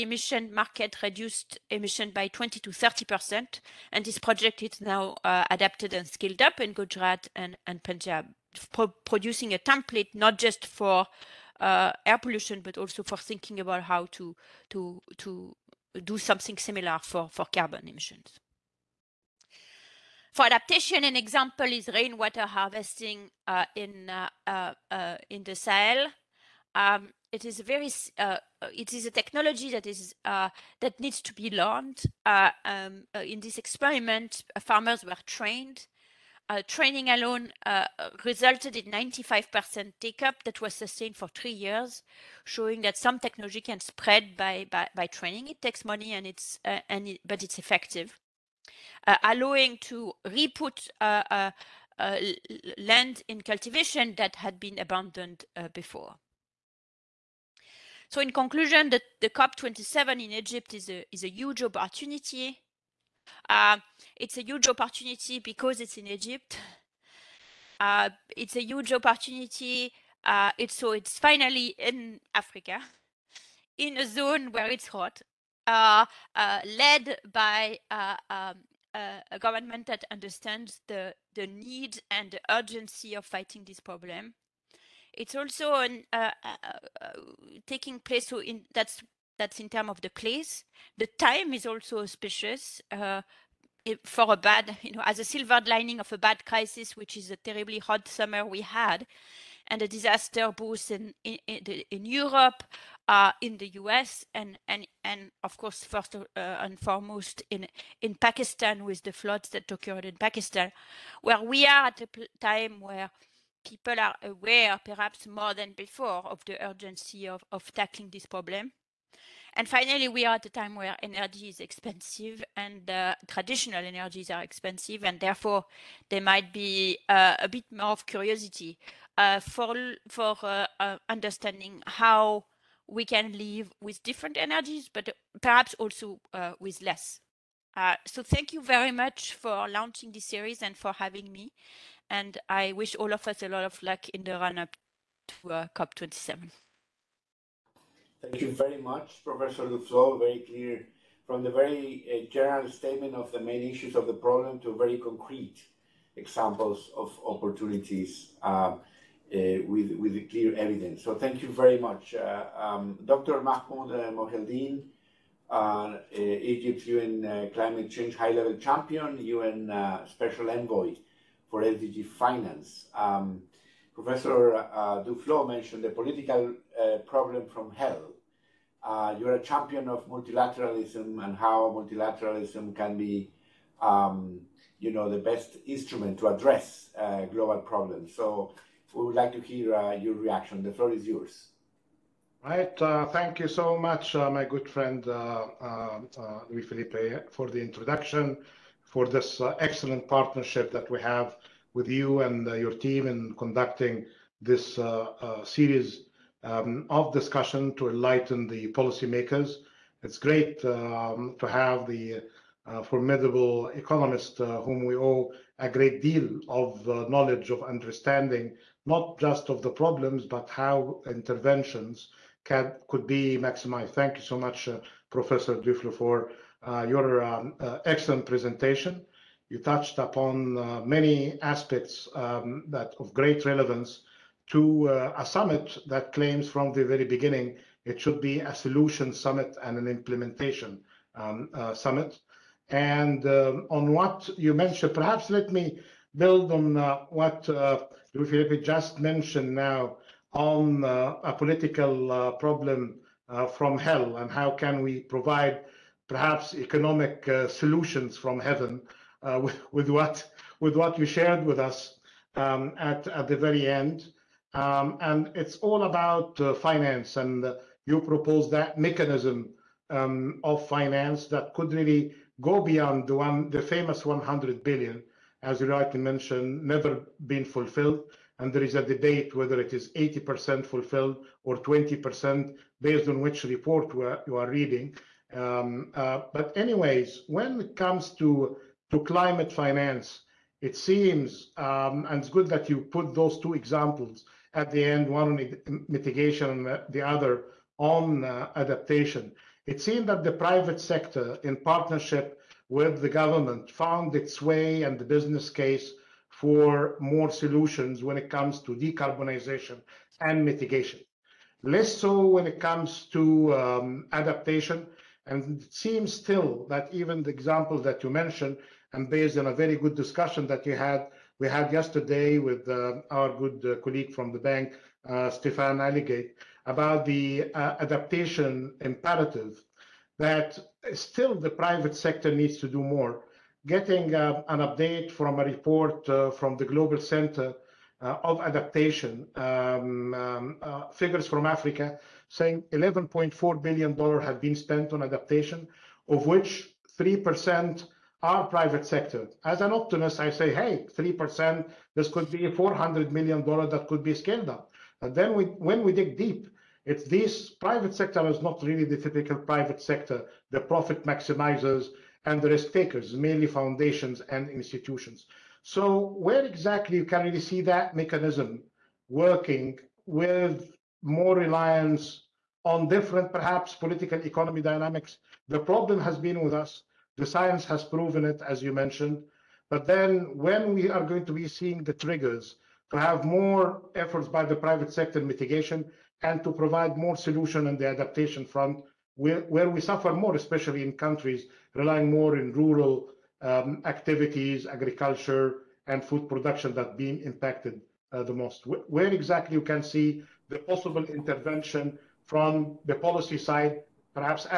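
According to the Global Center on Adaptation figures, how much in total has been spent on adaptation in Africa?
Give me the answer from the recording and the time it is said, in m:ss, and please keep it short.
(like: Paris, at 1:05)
$11.4 billion, at 5:42.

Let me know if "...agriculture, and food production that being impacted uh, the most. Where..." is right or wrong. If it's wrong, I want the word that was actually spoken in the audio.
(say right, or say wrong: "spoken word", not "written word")
right.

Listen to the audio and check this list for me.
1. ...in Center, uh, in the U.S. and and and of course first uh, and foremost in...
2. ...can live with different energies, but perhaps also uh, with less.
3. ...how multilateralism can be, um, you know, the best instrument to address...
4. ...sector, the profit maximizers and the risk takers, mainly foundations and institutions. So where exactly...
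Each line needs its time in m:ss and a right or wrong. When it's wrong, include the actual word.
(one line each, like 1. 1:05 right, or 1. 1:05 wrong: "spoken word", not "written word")
1. 1:41 wrong: "Europe", not "Center"
2. 2:13 right
3. 3:01 right
4. 5:59 right.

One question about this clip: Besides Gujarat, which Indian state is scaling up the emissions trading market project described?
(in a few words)
Punjab.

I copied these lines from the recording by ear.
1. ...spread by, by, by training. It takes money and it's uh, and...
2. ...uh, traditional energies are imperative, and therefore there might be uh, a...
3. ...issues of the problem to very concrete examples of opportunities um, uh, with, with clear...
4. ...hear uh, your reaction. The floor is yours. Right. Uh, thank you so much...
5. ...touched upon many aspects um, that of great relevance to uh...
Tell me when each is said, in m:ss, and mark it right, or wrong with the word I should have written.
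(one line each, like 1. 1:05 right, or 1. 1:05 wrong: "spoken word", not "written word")
1. 0:43 right
2. 2:02 wrong: "expensive", not "imperative"
3. 2:33 right
4. 3:09 right
5. 3:49 right.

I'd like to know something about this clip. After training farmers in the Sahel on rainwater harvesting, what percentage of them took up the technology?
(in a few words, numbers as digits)
95%.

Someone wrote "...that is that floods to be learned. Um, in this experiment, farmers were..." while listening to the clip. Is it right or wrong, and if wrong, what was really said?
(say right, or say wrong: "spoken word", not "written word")
wrong: "needs", not "floods".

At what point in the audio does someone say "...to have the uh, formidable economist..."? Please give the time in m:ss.
3:31.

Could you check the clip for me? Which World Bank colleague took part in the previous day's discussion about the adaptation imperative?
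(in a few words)
Stéphane Hallegatte.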